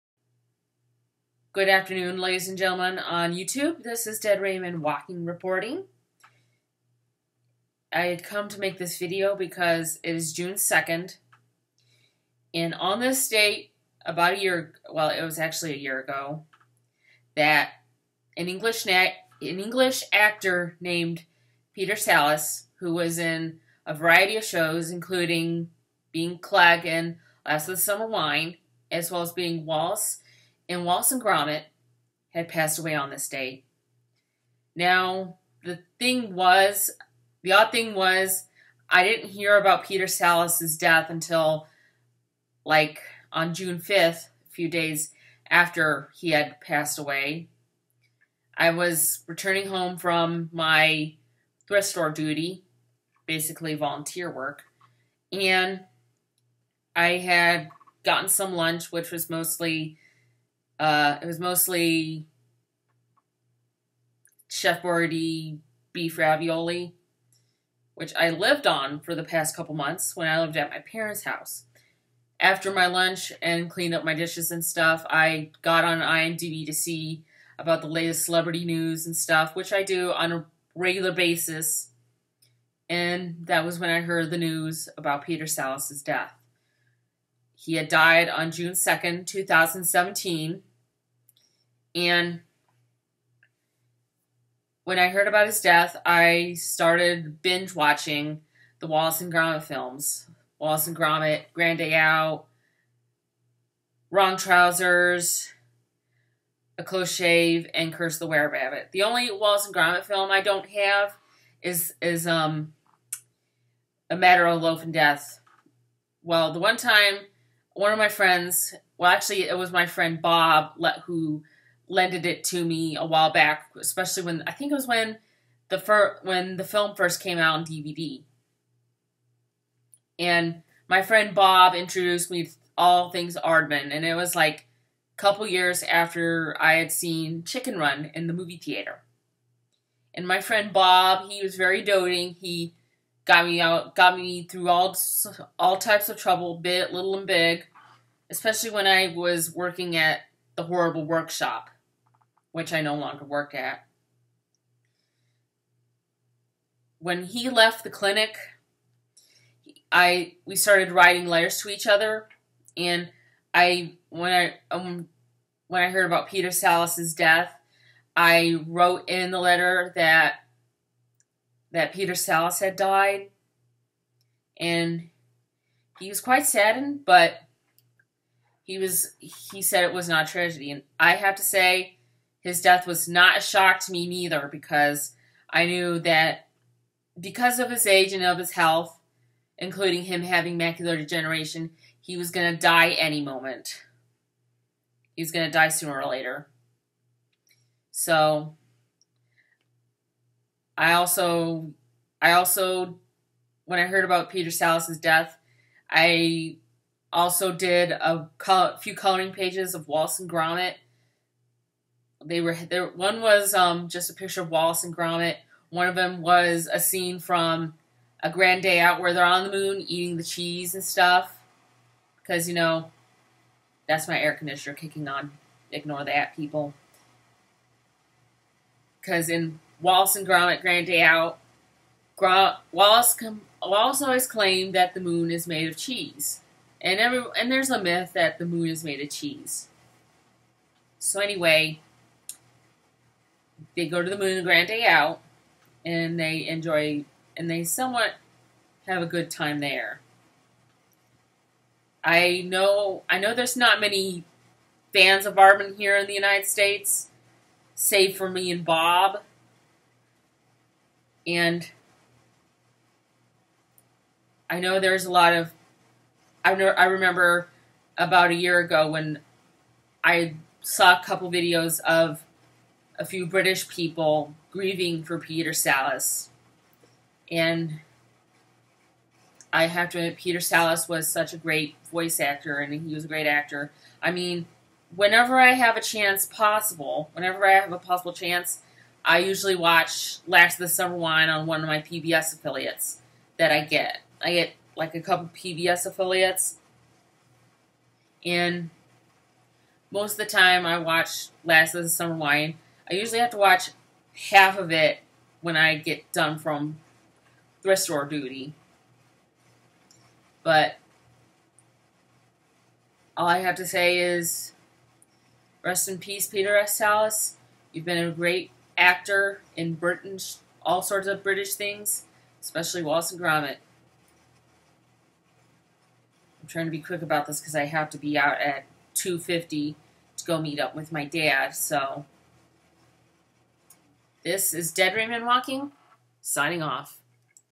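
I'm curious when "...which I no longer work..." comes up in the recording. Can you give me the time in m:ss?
2:32.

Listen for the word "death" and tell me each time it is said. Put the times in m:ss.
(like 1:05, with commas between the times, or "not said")
0:40, 1:26, 1:35, 1:54, 2:47, 3:02, 3:24.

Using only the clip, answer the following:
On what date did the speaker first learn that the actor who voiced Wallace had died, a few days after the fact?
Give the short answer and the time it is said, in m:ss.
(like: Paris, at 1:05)
June 5th, at 0:43.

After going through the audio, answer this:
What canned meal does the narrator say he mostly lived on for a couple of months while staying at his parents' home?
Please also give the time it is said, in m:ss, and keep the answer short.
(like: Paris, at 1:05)
Chef Boyardee beef ravioli, at 1:04.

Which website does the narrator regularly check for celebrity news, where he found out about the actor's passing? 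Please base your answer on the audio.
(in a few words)
IMDb.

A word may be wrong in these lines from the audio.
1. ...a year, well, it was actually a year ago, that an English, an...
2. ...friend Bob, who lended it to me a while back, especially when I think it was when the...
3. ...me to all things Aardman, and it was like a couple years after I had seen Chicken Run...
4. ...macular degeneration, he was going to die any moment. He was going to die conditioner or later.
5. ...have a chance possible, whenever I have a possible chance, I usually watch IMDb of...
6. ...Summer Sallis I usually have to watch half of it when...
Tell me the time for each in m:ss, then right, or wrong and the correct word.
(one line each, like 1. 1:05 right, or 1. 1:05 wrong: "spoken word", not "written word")
1. 0:14 right
2. 1:59 right
3. 2:12 right
4. 3:10 wrong: "sooner", not "conditioner"
5. 4:45 wrong: "Last", not "IMDb"
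6. 5:01 wrong: "Wine", not "Sallis".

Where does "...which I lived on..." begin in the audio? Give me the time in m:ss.
1:07.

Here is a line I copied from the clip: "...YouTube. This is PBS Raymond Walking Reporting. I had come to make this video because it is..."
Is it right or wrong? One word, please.
wrong.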